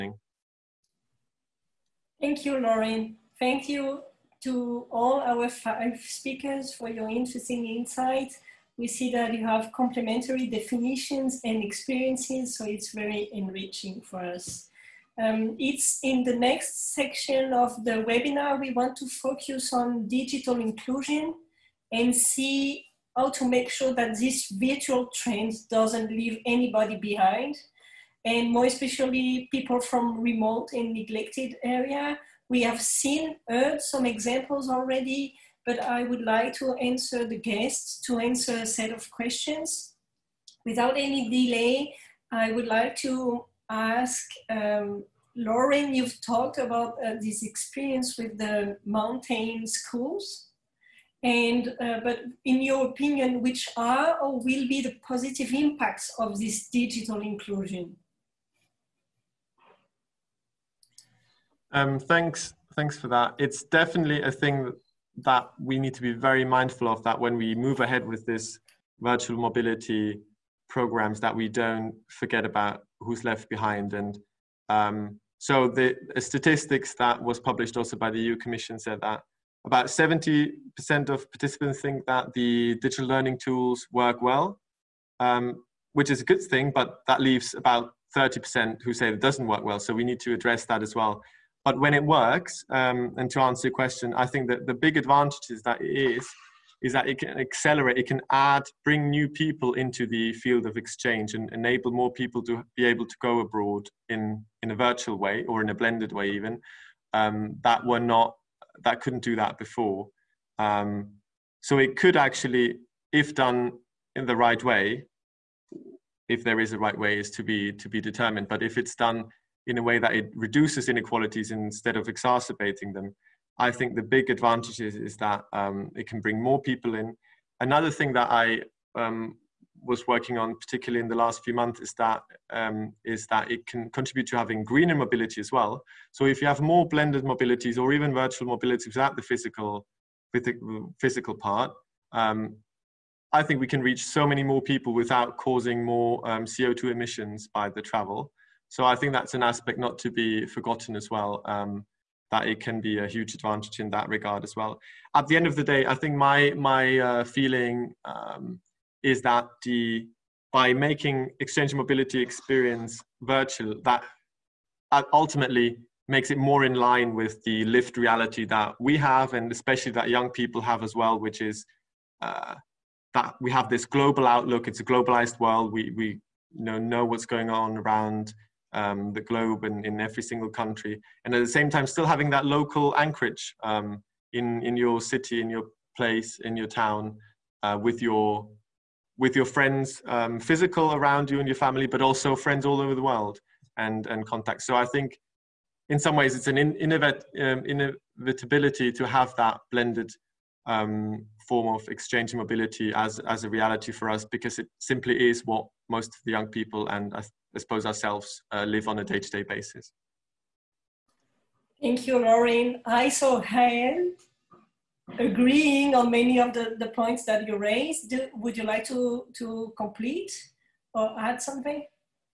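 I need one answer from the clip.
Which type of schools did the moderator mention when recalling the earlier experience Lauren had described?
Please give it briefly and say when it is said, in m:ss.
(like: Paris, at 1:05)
mountain schools, at 0:48.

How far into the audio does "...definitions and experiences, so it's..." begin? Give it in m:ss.
0:10.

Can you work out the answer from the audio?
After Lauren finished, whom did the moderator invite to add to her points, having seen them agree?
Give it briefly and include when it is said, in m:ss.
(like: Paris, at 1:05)
Rahel, at 3:33.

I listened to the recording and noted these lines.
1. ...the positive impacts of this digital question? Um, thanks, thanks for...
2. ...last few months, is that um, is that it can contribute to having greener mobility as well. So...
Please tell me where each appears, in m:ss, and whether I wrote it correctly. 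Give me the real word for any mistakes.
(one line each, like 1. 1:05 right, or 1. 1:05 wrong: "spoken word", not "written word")
1. 0:54 wrong: "inclusion", not "question"
2. 2:11 right.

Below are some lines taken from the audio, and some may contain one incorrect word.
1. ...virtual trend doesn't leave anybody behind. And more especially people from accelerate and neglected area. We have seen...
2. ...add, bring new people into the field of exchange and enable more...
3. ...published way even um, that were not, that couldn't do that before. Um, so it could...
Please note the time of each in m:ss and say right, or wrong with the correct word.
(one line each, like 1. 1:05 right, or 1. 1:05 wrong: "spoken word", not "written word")
1. 0:24 wrong: "remote", not "accelerate"
2. 1:38 right
3. 1:45 wrong: "blended", not "published".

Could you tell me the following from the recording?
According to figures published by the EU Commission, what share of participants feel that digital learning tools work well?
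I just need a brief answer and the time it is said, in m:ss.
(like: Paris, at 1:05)
70%, at 1:19.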